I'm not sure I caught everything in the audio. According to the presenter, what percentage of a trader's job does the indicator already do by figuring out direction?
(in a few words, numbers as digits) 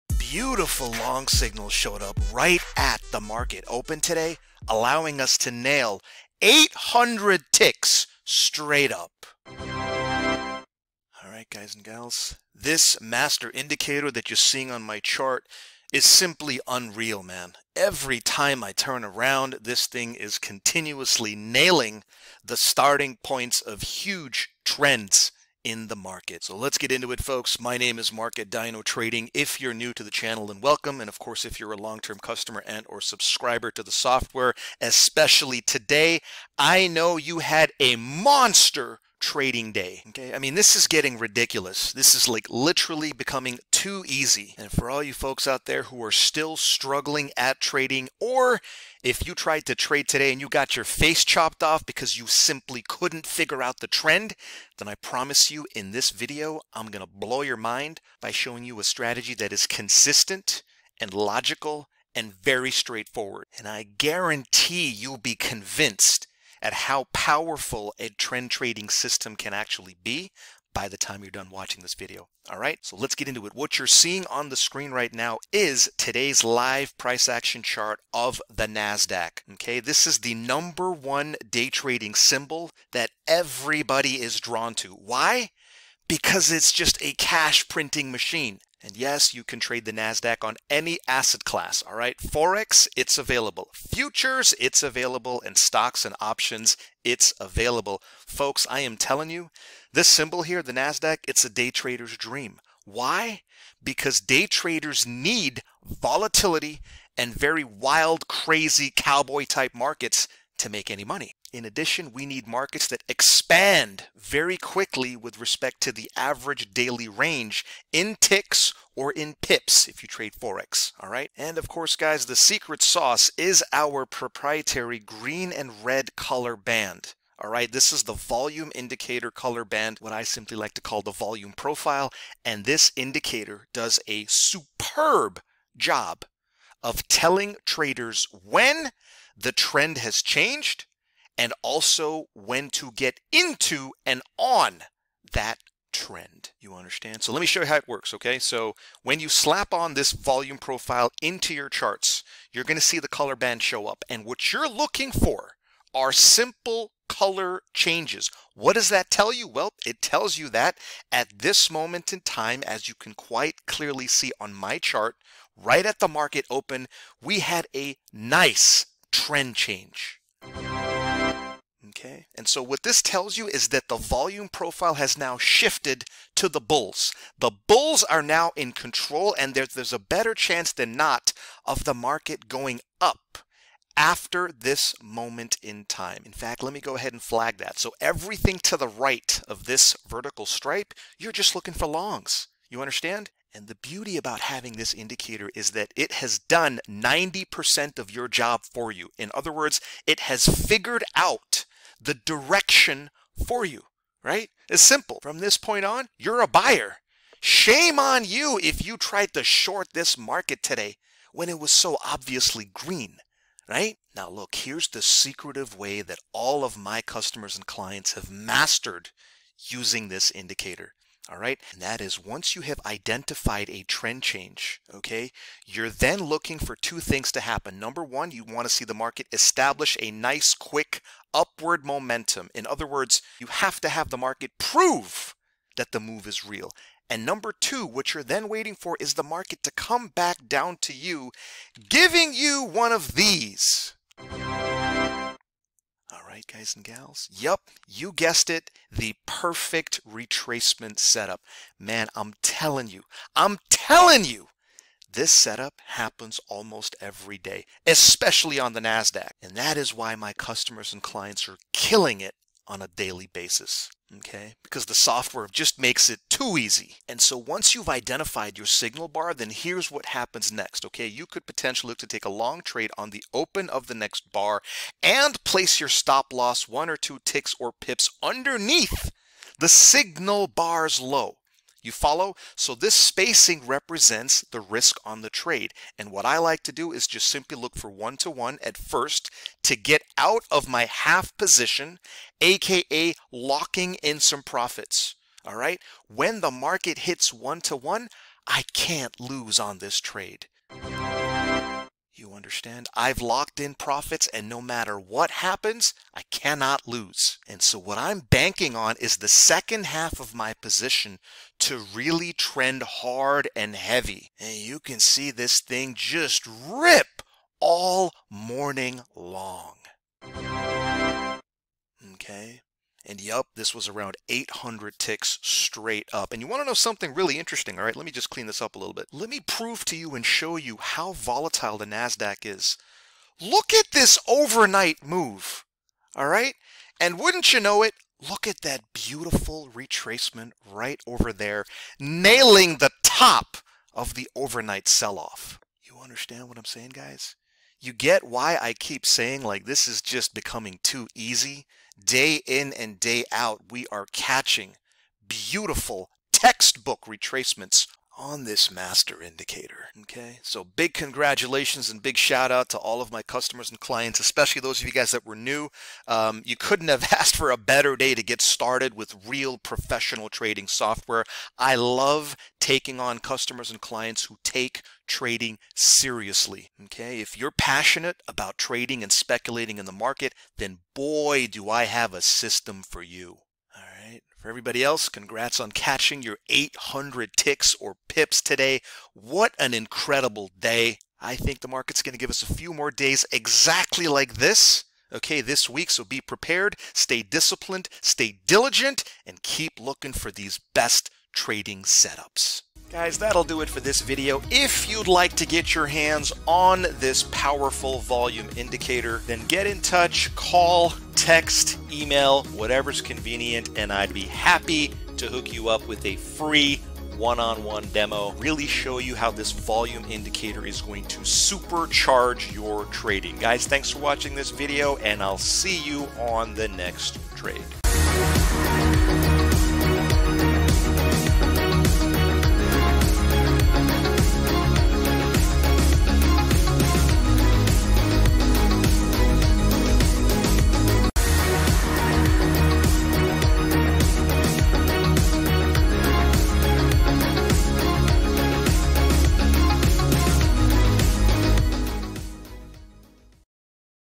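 90%.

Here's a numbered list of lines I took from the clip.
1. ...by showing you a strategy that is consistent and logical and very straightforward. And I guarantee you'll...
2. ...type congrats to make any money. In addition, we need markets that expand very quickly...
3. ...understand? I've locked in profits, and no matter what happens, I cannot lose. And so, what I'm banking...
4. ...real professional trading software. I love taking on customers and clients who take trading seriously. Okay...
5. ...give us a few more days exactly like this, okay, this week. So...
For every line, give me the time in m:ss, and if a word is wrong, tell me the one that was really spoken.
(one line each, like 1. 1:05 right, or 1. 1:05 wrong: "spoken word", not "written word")
1. 0:58 right
2. 1:49 wrong: "markets", not "congrats"
3. 5:02 right
4. 6:09 right
5. 6:32 right.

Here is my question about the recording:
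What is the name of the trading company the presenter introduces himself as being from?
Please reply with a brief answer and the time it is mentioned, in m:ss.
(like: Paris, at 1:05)
Dyno Trading, at 0:28.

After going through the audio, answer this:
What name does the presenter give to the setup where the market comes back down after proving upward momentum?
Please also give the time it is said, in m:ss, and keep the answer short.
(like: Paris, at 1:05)
perfect retracement setup, at 4:08.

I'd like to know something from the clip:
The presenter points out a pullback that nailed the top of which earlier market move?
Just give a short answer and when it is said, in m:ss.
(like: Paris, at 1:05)
overnight sell-off, at 5:44.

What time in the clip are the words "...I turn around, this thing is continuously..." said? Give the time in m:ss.
0:18.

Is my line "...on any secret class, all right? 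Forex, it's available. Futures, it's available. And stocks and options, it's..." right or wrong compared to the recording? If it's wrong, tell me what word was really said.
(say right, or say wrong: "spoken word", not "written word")
wrong: "asset", not "secret".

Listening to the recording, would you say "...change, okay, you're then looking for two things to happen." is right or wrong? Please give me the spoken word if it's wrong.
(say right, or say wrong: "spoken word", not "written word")
right.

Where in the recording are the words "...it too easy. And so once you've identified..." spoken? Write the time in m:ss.
4:26.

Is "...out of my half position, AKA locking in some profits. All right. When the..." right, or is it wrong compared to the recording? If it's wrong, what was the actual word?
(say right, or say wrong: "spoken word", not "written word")
right.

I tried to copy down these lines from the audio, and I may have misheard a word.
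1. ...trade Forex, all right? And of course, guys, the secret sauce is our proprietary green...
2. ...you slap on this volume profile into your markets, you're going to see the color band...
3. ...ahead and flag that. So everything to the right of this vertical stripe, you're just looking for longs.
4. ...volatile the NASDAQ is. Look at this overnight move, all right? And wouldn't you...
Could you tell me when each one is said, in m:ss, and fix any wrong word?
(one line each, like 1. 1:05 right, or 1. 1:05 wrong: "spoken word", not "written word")
1. 2:00 right
2. 2:29 wrong: "charts", not "markets"
3. 3:06 right
4. 5:31 right.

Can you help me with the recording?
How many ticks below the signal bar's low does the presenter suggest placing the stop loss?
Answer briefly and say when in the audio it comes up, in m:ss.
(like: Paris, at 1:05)
1 or 2, at 4:36.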